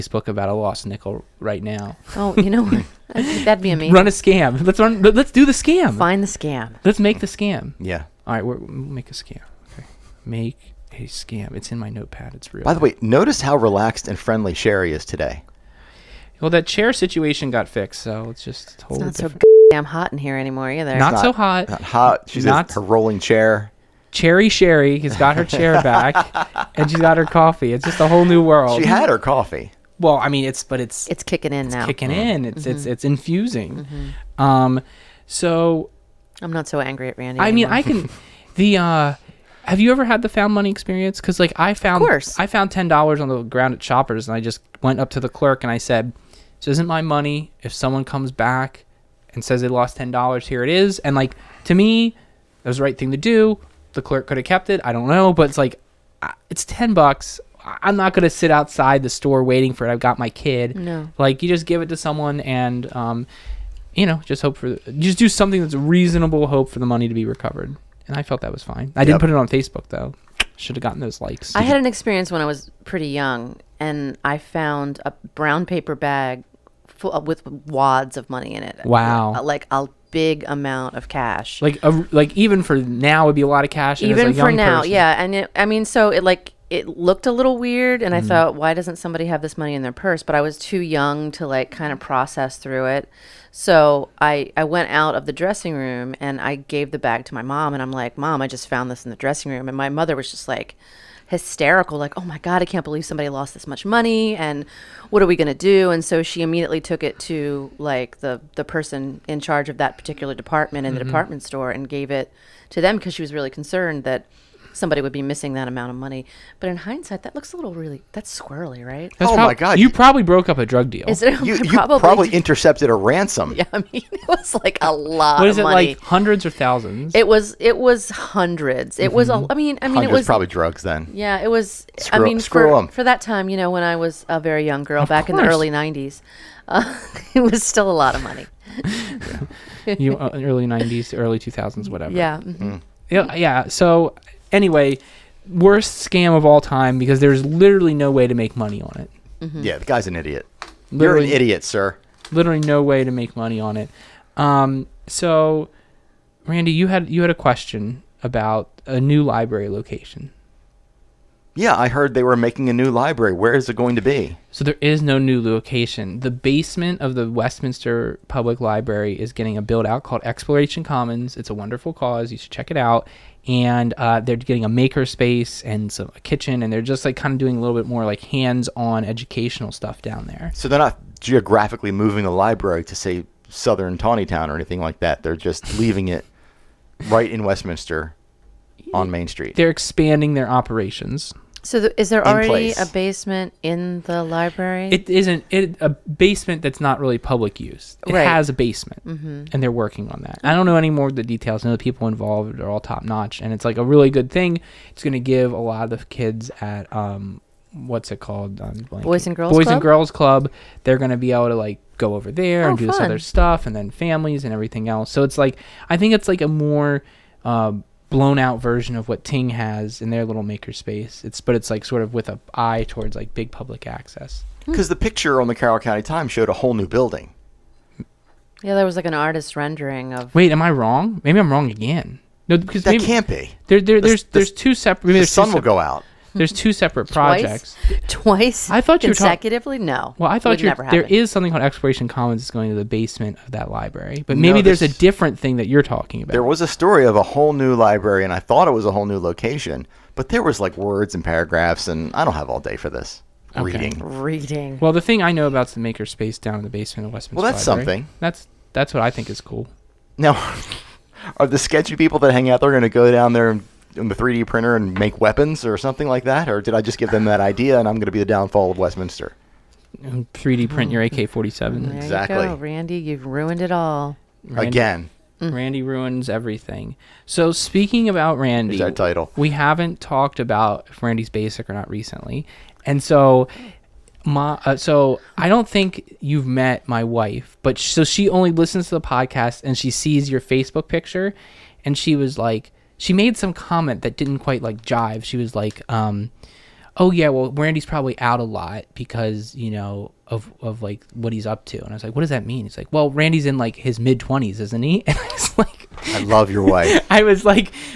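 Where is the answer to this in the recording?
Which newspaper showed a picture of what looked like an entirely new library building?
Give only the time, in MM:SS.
03:45.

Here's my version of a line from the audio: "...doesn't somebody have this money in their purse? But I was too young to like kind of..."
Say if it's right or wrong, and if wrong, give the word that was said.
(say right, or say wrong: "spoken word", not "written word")
right.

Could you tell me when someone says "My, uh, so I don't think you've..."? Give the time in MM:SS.
04:44.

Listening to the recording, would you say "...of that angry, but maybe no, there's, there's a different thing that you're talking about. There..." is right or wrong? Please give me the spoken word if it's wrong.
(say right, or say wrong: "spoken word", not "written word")
wrong: "library", not "angry".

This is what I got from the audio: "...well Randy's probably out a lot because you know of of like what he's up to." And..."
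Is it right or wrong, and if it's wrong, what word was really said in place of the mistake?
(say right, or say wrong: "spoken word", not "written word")
right.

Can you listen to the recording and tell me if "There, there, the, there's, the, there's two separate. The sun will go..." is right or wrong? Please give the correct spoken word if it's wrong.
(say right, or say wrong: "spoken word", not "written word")
right.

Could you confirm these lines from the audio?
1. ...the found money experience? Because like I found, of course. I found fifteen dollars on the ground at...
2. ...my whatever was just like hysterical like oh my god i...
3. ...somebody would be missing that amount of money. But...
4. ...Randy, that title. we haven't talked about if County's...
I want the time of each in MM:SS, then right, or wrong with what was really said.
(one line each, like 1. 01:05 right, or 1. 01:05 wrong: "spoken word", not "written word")
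1. 00:40 wrong: "ten", not "fifteen"
2. 01:39 wrong: "mother", not "whatever"
3. 01:54 right
4. 04:38 wrong: "Randy", not "County".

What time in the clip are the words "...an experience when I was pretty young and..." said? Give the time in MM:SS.
01:11.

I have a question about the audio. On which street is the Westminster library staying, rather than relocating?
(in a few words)
Main Street.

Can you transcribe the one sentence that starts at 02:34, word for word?
Um, so, Randy, you had you had a question about a new library location.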